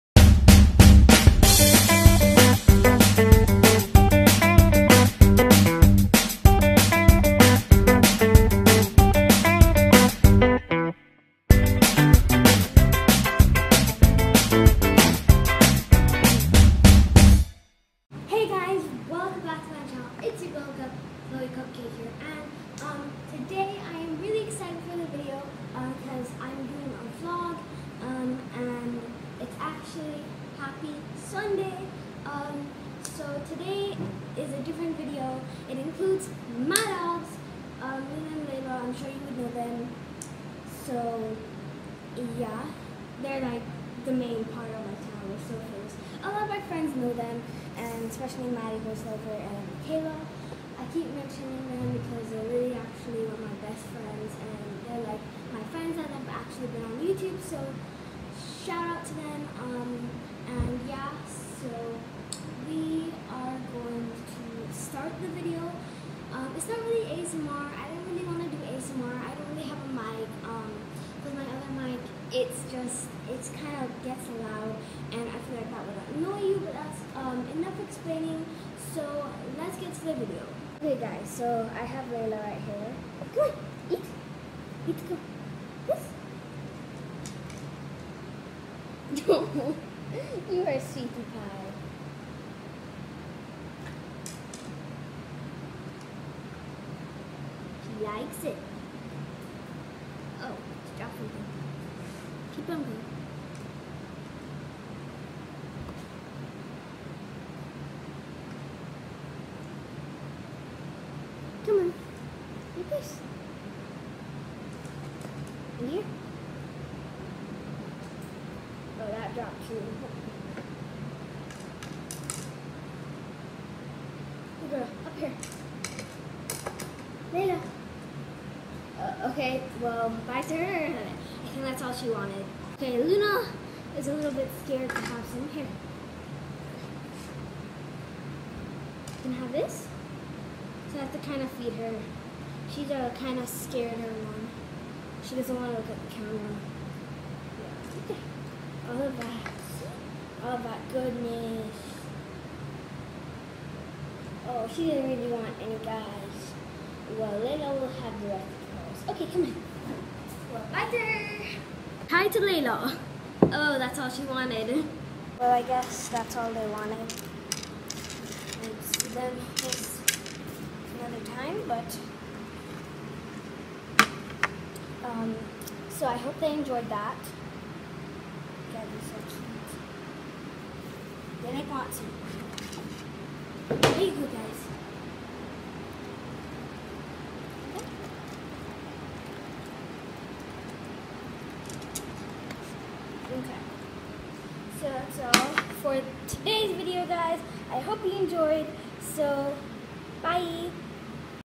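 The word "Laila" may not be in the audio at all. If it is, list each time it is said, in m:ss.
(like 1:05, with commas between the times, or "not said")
0:38, 1:22, 2:07, 2:37, 2:42.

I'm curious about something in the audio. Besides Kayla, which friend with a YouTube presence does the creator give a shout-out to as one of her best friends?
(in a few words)
Maddie Horselover.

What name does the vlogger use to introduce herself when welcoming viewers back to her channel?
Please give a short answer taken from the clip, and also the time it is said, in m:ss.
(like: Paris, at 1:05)
Chloe Cupcake, at 0:21.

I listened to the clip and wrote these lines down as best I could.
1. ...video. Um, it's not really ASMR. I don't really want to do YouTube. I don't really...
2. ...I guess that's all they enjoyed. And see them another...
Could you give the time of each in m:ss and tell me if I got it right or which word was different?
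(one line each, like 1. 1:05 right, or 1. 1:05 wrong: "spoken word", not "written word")
1. 1:05 wrong: "ASMR", not "YouTube"
2. 2:45 wrong: "wanted", not "enjoyed".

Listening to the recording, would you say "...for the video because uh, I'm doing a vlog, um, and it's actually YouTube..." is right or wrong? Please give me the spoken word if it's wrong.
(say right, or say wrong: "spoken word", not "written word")
wrong: "Happy", not "YouTube".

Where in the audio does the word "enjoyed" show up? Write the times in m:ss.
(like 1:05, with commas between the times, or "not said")
2:56, 3:18.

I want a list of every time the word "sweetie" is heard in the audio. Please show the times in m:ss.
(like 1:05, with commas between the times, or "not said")
1:30.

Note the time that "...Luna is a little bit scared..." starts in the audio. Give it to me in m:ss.
2:13.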